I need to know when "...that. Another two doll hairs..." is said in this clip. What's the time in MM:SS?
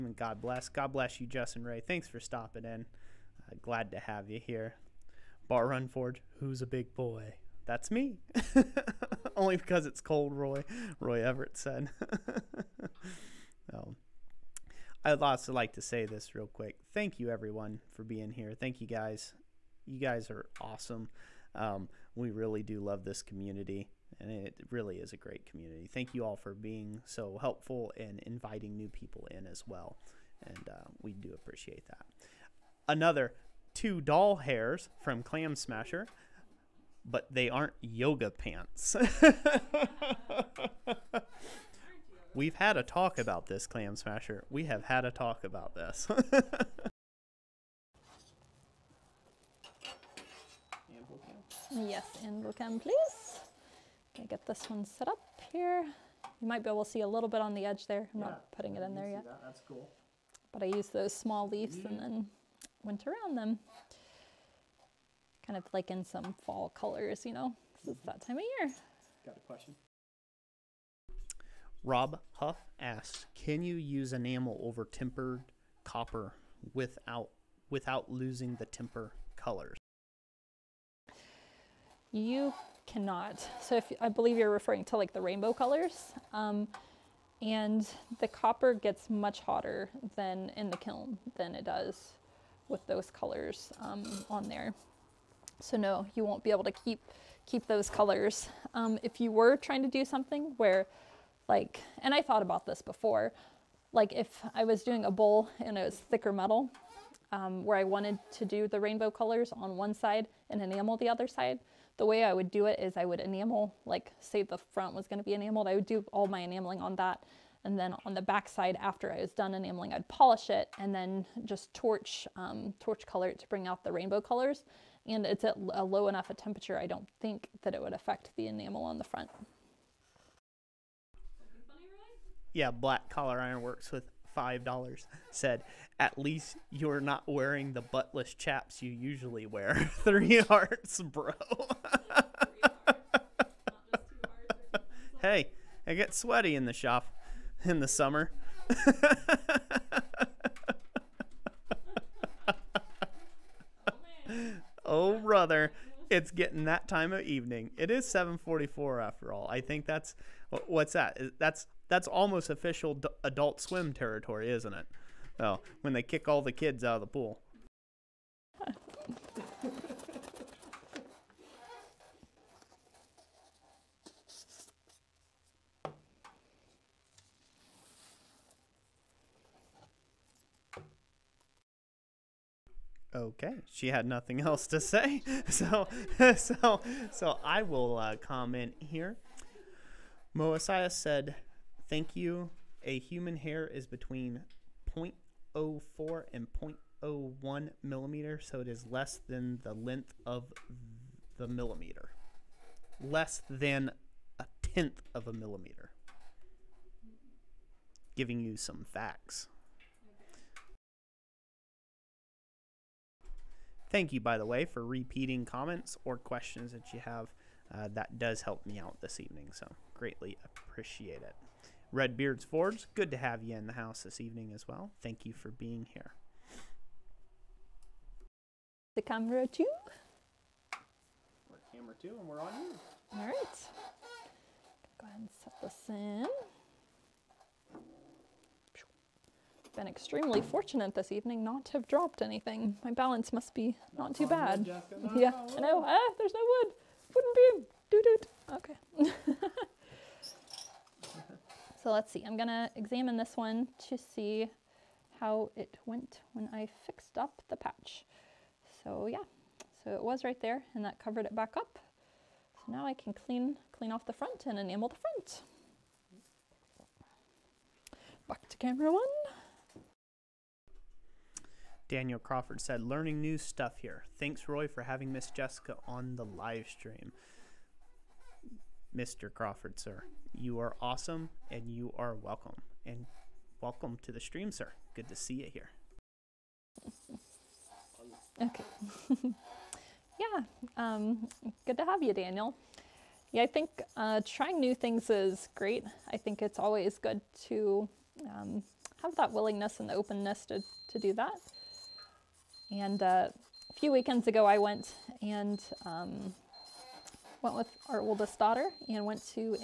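00:31.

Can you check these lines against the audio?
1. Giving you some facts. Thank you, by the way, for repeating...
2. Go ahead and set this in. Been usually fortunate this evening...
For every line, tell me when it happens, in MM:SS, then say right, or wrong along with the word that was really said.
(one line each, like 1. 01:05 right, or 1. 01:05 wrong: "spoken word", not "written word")
1. 03:28 right
2. 03:55 wrong: "extremely", not "usually".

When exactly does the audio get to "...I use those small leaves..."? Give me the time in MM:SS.
01:00.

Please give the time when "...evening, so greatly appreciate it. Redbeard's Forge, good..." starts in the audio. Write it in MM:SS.
03:39.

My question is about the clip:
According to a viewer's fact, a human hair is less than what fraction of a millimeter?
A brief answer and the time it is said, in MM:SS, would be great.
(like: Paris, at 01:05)
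A tenth, at 03:24.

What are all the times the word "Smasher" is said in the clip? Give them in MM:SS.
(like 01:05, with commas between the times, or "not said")
00:35, 00:43.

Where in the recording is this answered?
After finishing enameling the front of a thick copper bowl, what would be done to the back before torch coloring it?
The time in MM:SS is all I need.
01:59.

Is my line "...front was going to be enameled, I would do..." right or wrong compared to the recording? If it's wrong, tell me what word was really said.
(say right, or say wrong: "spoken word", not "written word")
right.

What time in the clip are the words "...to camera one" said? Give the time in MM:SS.
04:28.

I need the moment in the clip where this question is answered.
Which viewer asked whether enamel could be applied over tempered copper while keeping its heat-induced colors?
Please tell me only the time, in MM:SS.
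01:11.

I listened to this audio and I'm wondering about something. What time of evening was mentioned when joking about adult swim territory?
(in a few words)
7:44.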